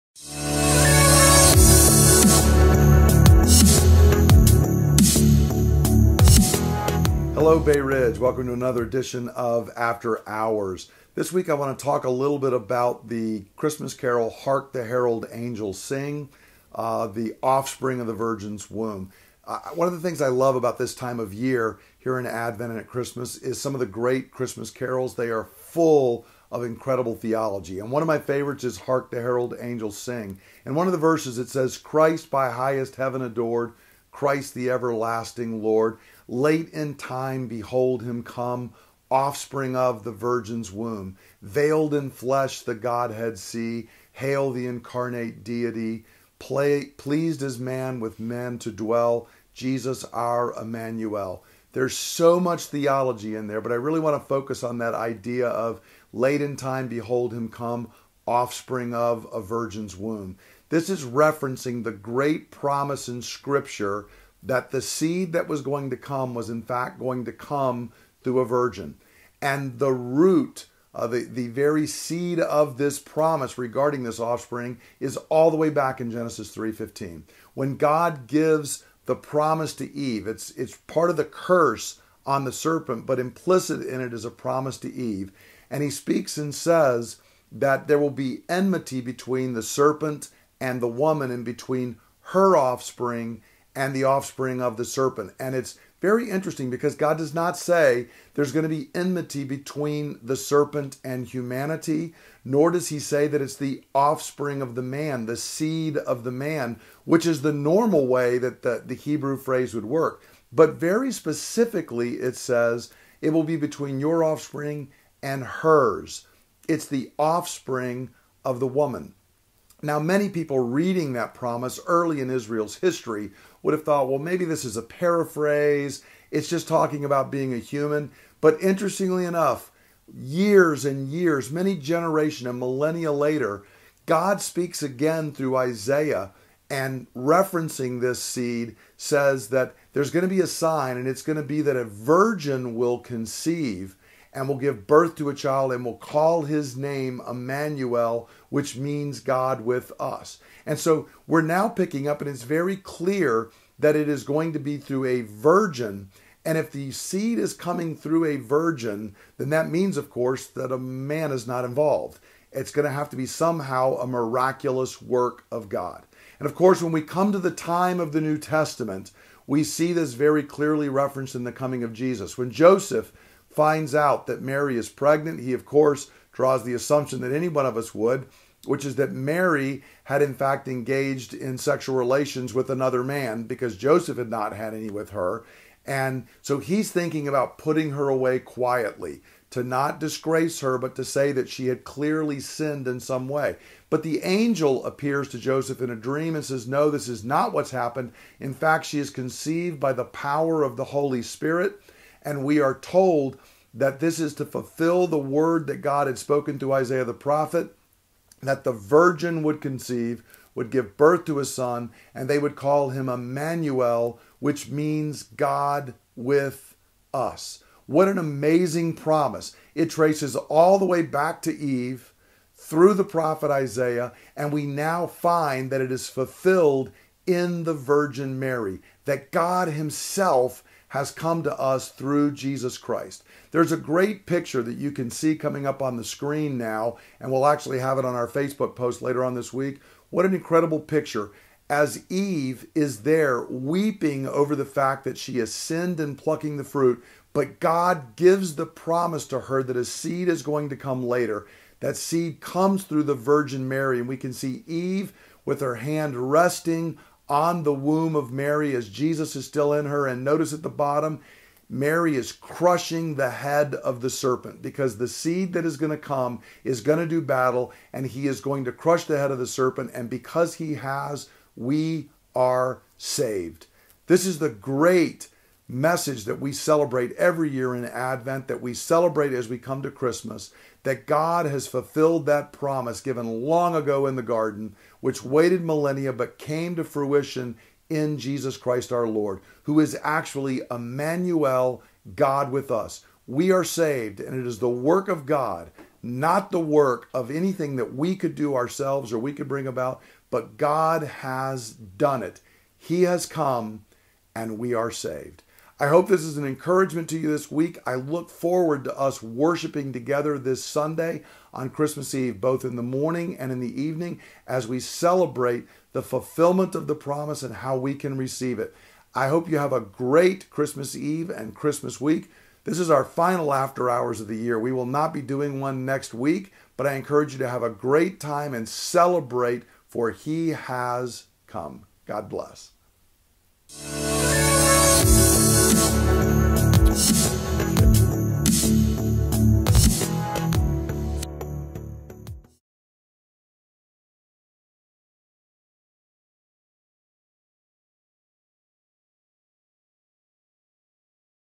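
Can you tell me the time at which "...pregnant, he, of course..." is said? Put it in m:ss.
2:54.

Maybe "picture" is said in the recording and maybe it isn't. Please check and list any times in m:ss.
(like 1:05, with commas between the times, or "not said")
3:54, 4:00.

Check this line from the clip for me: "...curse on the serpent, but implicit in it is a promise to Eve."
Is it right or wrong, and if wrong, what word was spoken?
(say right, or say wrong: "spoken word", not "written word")
right.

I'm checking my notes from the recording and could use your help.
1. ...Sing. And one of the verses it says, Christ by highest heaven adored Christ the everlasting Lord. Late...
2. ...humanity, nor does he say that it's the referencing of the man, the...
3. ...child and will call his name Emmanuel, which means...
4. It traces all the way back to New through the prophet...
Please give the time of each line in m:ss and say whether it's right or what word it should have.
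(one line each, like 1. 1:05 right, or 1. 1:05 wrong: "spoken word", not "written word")
1. 0:29 right
2. 1:41 wrong: "offspring", not "referencing"
3. 2:25 right
4. 3:39 wrong: "Eve", not "New".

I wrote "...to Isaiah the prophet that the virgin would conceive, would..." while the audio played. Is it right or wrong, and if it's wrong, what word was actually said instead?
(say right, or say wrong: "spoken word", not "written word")
right.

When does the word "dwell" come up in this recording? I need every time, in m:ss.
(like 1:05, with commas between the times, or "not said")
0:48.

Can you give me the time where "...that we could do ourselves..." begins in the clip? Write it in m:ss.
4:57.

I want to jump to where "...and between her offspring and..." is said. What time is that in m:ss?
1:31.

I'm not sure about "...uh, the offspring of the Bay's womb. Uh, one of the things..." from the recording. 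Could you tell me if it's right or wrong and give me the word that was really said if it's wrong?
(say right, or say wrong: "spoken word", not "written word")
wrong: "Virgin", not "Bay".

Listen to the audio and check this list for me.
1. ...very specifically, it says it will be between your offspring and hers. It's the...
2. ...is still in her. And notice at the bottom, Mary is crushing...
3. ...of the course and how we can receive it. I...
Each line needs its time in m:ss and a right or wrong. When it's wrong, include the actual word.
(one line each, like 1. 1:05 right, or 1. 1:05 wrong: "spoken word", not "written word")
1. 1:50 right
2. 4:19 right
3. 5:16 wrong: "promise", not "course".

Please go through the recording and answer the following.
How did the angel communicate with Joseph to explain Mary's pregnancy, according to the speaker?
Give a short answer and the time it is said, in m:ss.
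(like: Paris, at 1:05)
In a dream, at 3:15.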